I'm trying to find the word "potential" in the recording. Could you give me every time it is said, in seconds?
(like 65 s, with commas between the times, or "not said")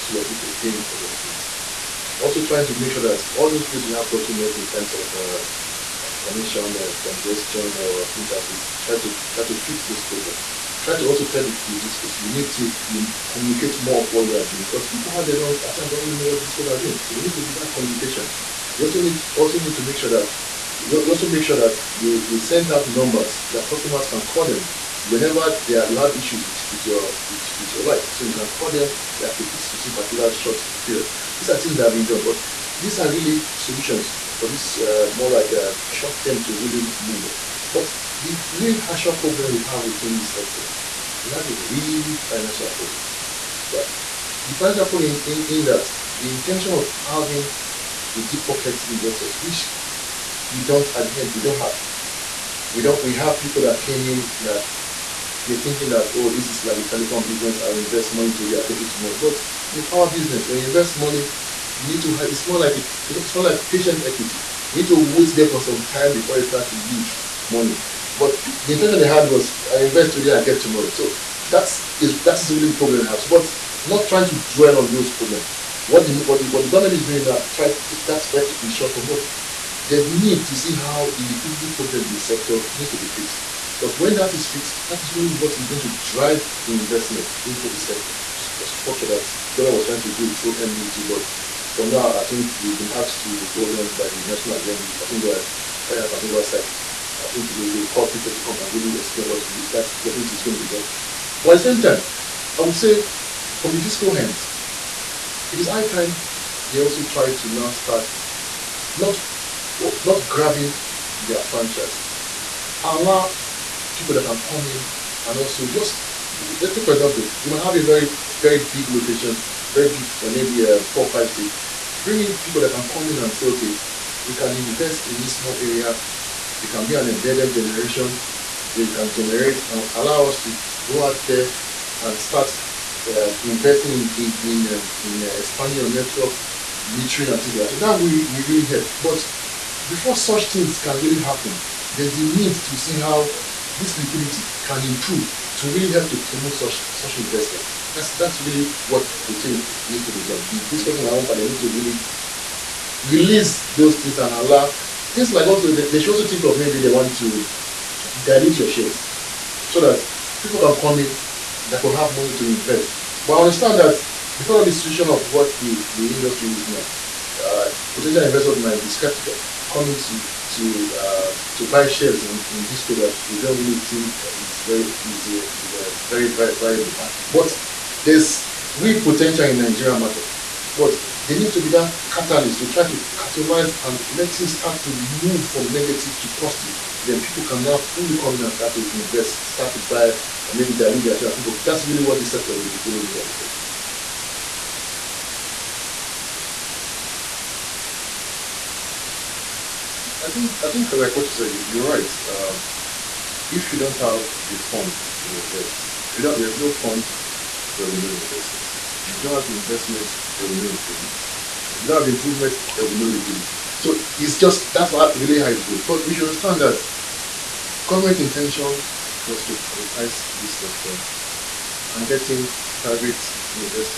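167 s, 179 s.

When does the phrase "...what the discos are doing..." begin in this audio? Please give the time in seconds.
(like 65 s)
16 s.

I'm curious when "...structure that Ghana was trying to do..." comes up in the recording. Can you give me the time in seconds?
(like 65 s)
88 s.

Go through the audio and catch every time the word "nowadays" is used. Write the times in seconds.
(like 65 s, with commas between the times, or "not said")
not said.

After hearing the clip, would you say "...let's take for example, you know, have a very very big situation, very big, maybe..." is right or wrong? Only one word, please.
wrong.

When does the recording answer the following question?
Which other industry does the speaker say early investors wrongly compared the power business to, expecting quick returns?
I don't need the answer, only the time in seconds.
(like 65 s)
56 s.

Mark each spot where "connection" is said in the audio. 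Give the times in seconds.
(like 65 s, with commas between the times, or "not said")
6 s.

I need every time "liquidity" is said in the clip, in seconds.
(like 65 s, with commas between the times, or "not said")
81 s, 143 s, 213 s.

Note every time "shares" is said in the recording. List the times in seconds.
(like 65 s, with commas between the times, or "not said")
158 s, 171 s, 191 s.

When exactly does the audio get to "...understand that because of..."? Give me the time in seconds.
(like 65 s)
163 s.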